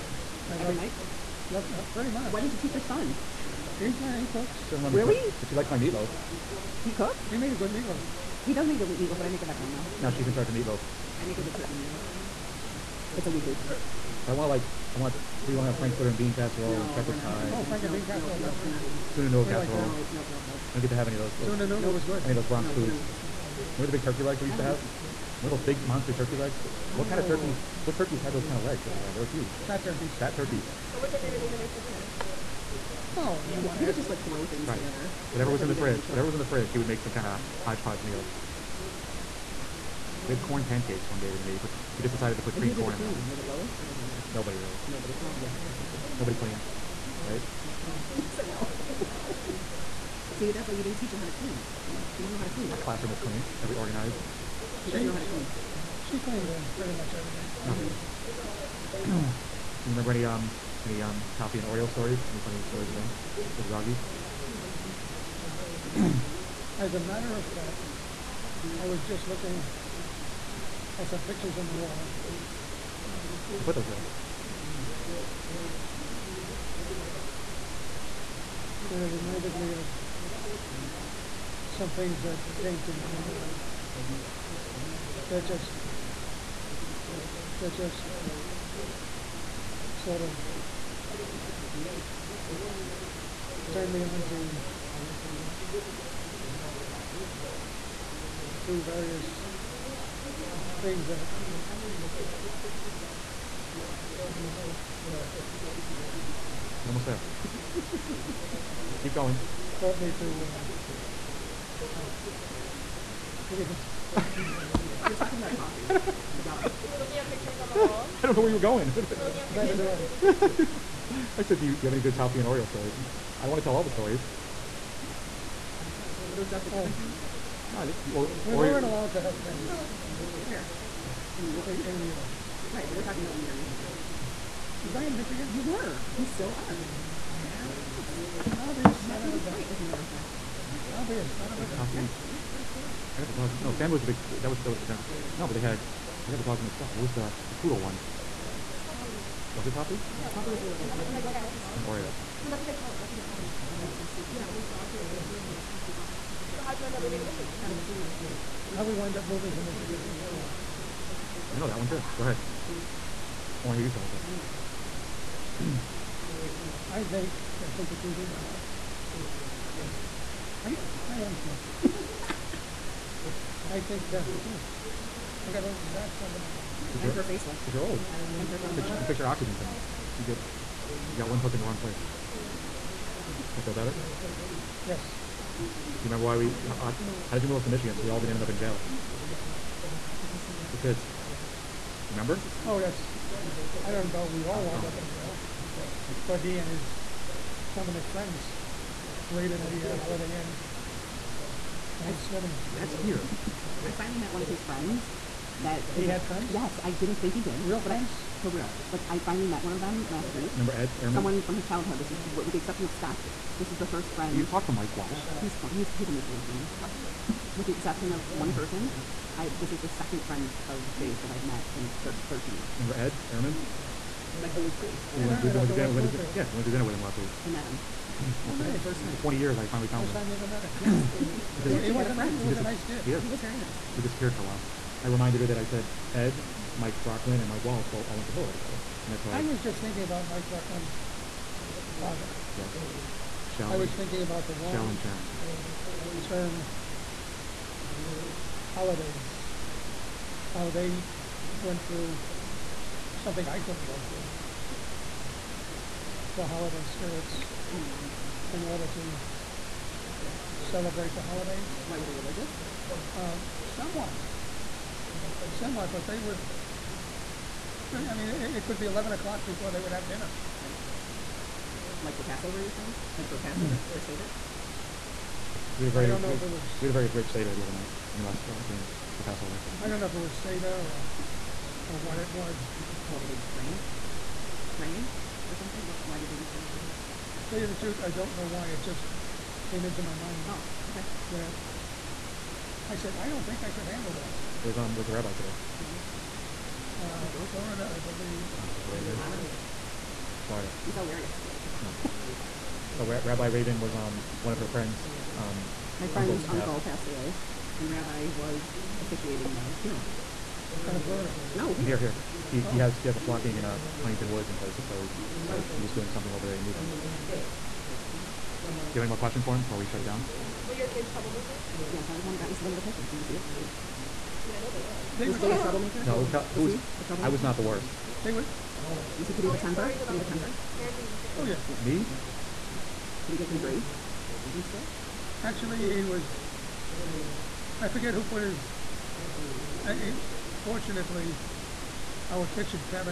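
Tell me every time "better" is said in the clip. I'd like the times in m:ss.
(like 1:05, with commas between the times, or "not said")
0:09, 3:03.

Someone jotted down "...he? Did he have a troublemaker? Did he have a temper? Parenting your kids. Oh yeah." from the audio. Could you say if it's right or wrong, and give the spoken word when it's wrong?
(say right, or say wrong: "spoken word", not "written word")
wrong: "temper", not "troublemaker".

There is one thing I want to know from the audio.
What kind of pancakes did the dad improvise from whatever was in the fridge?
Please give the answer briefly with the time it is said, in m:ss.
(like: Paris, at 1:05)
corn pancakes, at 0:40.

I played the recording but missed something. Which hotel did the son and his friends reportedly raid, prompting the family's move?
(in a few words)
Holiday Inn.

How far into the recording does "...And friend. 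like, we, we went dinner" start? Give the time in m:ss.
3:45.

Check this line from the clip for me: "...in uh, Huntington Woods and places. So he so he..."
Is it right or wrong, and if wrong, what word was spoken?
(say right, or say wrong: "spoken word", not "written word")
right.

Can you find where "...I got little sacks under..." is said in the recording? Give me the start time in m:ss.
2:55.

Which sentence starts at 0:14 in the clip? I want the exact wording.
But I want like, I want.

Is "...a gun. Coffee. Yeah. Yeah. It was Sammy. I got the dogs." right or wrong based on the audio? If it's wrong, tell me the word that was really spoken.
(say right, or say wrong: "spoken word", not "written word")
right.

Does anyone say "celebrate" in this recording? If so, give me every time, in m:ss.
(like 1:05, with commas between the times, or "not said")
4:20.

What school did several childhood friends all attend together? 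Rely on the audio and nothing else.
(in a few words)
Hillel.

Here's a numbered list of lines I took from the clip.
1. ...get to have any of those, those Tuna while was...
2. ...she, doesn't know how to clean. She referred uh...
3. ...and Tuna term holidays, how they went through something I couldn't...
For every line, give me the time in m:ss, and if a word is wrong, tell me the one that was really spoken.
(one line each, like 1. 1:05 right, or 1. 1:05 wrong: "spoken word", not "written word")
1. 0:20 wrong: "noodle", not "while"
2. 0:54 wrong: "cleaned", not "referred"
3. 4:04 wrong: "Sharon", not "Tuna".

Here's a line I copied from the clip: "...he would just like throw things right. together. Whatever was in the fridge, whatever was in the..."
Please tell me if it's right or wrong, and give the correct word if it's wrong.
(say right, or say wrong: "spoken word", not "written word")
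right.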